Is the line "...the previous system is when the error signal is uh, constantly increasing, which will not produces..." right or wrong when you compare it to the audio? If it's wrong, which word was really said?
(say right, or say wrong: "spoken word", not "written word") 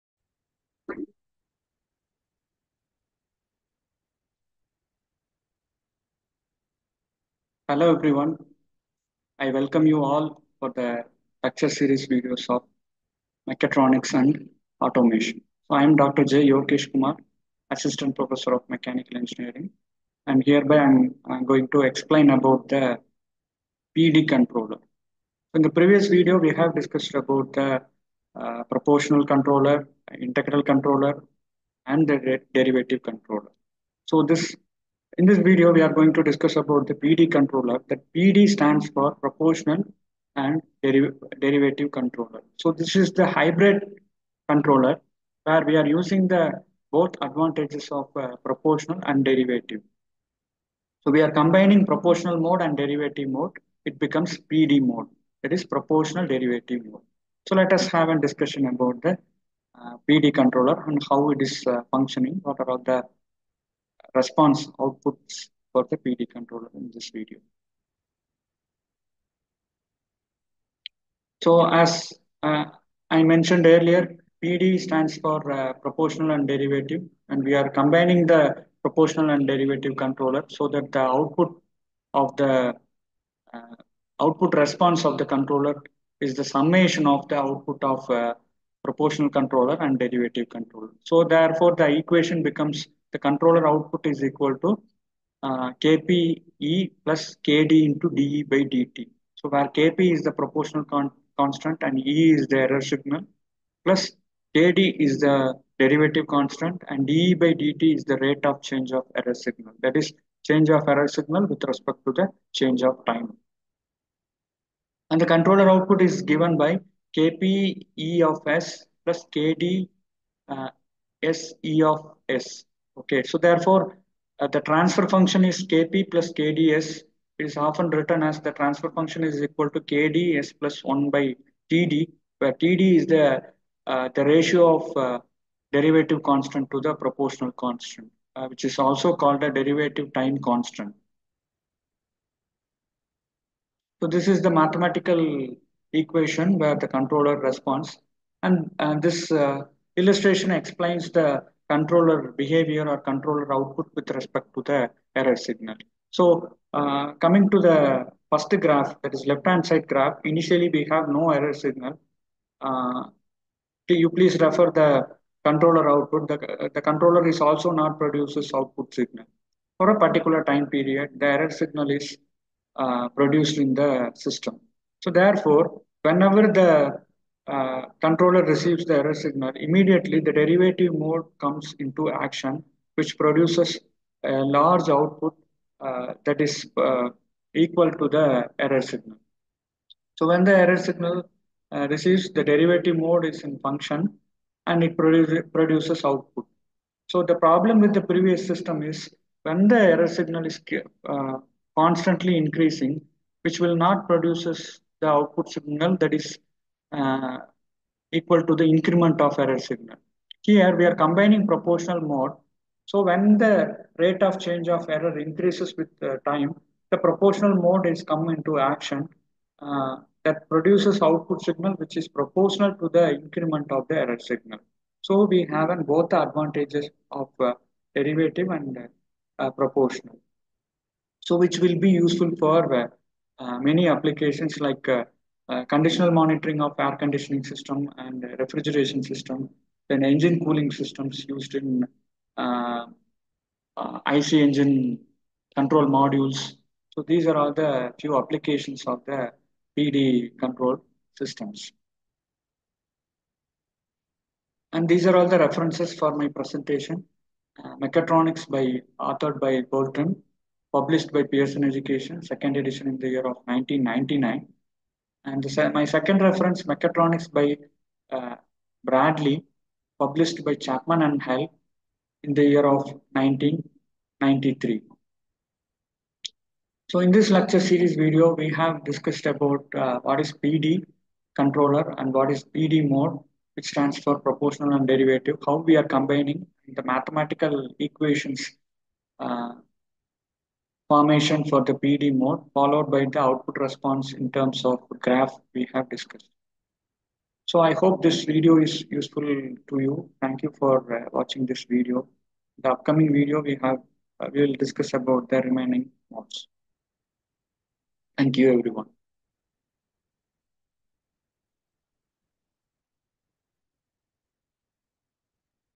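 right.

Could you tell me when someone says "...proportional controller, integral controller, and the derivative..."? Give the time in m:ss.
0:28.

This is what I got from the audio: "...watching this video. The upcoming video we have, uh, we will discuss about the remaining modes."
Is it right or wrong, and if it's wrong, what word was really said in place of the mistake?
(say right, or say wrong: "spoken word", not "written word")
right.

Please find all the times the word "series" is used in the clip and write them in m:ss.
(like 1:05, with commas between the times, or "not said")
0:11, 4:37.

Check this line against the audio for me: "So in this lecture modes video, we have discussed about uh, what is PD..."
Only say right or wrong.
wrong.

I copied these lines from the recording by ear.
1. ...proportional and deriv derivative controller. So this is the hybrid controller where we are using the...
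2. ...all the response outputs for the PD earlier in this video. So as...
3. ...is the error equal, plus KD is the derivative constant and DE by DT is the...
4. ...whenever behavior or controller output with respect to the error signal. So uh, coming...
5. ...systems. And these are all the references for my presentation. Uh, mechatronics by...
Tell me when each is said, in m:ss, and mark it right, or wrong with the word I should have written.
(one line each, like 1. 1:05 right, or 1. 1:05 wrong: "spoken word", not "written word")
1. 0:39 right
2. 1:02 wrong: "controller", not "earlier"
3. 1:42 wrong: "signal", not "equal"
4. 2:31 wrong: "controller", not "whenever"
5. 4:11 right.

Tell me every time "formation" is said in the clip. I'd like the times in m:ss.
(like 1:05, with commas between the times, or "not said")
4:50.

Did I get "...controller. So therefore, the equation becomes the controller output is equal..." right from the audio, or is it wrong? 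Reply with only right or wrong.
right.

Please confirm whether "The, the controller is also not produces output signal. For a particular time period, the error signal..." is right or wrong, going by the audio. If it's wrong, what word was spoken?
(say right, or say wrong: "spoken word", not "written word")
right.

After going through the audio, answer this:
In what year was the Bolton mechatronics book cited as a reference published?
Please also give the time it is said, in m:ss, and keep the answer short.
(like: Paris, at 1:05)
1999, at 4:23.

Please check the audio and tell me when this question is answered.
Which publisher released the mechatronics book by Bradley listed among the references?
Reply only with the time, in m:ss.
4:30.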